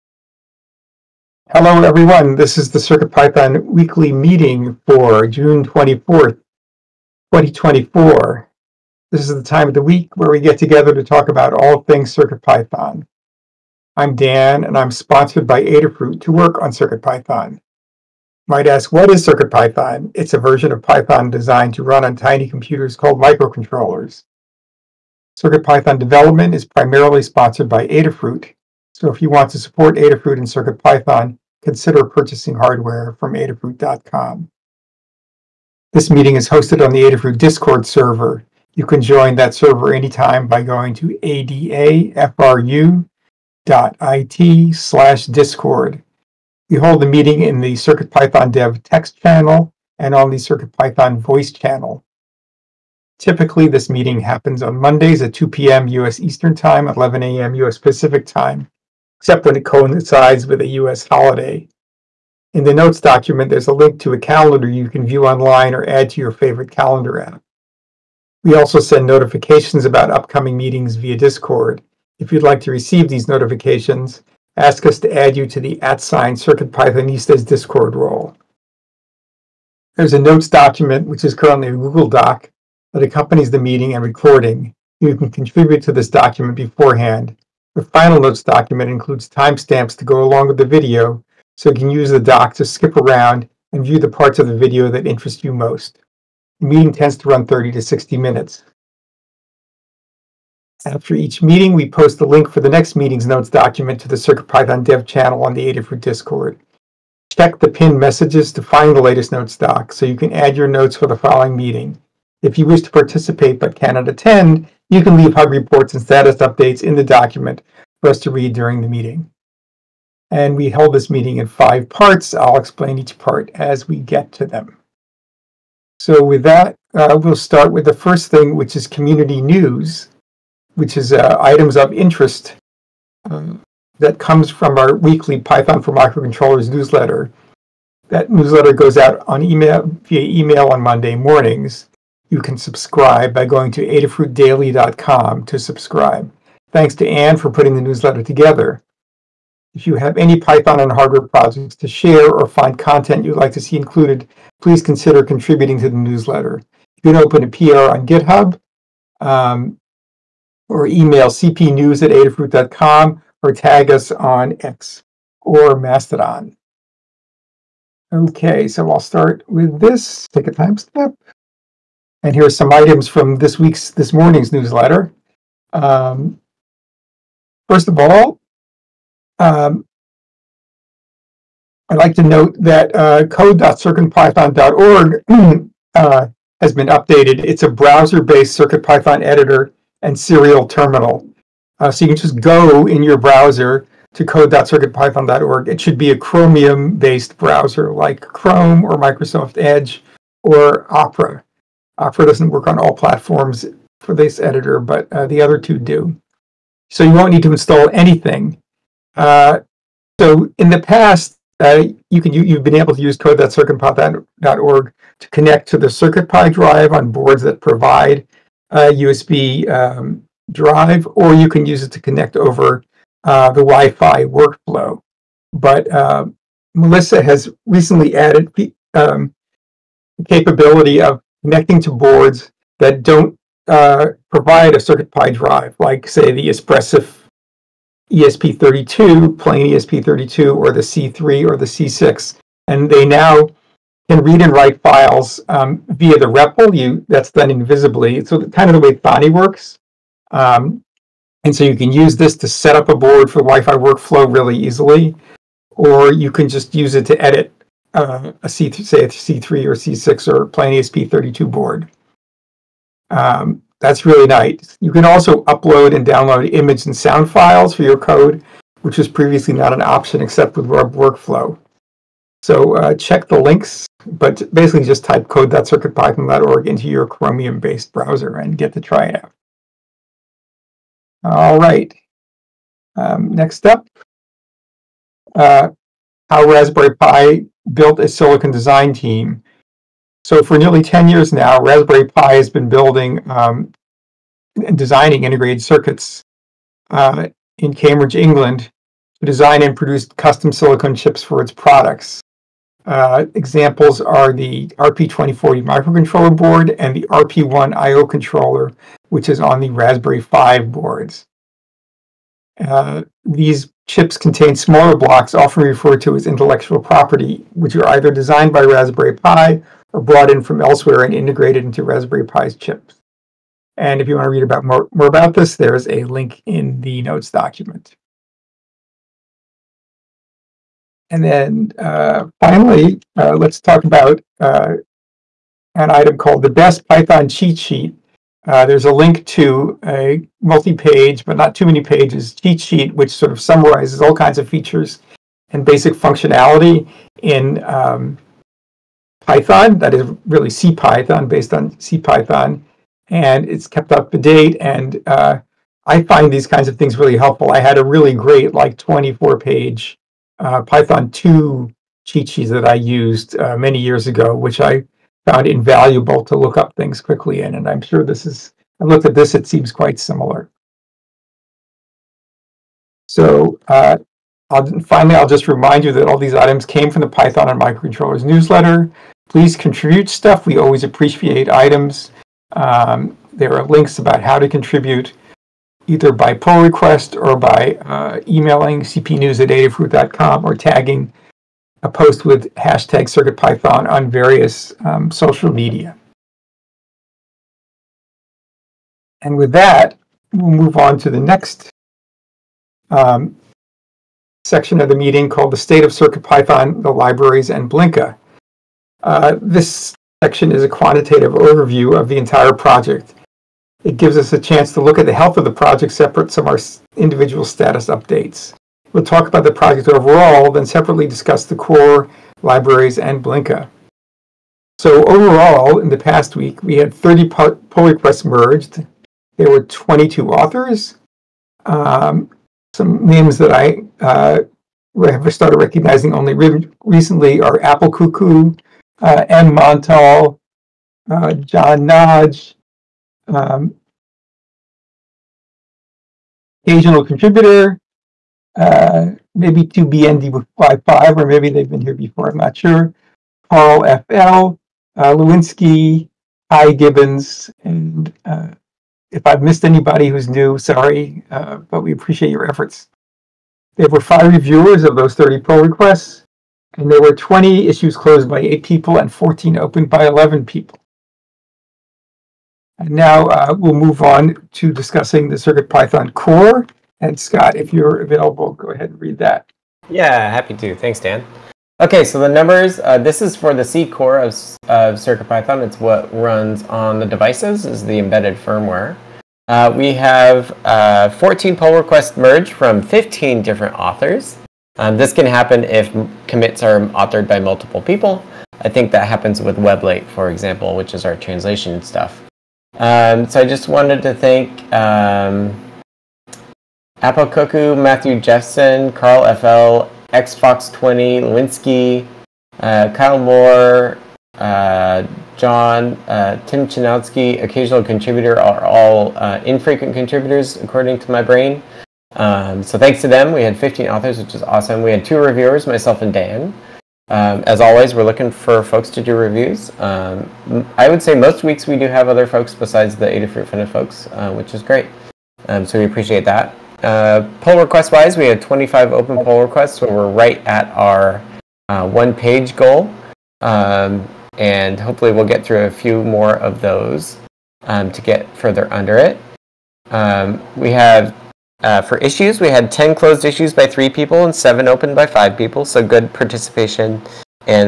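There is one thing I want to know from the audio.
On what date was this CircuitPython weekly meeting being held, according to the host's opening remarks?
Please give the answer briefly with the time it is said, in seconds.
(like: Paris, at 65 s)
June 24th, 2024, at 5 s.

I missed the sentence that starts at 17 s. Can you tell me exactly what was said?
You might ask, what is CircuitPython?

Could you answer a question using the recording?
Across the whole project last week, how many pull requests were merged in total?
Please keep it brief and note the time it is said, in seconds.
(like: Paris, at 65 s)
30, at 426 s.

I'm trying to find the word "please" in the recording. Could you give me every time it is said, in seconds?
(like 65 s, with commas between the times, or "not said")
154 s, 379 s.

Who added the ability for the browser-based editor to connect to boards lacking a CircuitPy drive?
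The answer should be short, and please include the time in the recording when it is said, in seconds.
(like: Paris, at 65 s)
Melissa, at 226 s.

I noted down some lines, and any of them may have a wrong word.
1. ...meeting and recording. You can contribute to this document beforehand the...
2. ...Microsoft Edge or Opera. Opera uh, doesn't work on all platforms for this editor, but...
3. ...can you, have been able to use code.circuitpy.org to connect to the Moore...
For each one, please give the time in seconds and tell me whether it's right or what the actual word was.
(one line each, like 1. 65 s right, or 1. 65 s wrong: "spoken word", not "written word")
1. 83 s right
2. 198 s right
3. 212 s wrong: "CircuitPy", not "Moore".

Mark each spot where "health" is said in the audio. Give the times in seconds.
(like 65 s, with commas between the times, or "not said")
415 s.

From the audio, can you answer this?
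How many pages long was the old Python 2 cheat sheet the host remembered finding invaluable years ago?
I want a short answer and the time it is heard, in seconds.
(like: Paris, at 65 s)
24, at 358 s.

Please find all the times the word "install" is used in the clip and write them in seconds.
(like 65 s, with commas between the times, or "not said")
207 s.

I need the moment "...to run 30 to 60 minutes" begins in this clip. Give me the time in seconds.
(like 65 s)
97 s.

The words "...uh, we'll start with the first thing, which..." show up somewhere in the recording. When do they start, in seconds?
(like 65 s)
126 s.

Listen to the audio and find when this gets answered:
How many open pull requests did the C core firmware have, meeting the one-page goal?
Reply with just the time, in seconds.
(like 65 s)
538 s.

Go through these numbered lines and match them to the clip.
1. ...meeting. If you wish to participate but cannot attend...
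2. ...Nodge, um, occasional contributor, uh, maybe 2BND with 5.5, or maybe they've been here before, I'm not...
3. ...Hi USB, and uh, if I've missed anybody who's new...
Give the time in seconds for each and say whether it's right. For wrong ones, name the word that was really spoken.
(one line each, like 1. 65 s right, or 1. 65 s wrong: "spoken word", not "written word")
1. 111 s right
2. 441 s right
3. 456 s wrong: "Gibbons", not "USB".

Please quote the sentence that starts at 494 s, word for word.
Um, this can happen if commits are authored by multiple people.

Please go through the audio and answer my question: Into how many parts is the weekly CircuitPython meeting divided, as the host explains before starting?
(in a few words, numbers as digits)
5.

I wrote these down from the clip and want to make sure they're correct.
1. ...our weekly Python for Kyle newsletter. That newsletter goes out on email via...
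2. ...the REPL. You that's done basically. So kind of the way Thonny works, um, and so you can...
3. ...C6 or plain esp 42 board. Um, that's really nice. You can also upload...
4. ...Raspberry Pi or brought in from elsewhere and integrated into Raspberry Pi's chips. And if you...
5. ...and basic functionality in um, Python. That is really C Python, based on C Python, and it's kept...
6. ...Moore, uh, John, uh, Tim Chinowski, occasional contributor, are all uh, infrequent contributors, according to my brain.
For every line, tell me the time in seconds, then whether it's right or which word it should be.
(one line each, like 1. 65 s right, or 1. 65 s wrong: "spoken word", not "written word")
1. 134 s wrong: "Microcontrollers", not "Kyle"
2. 246 s wrong: "invisibly", not "basically"
3. 259 s wrong: "32", not "42"
4. 318 s right
5. 345 s right
6. 513 s right.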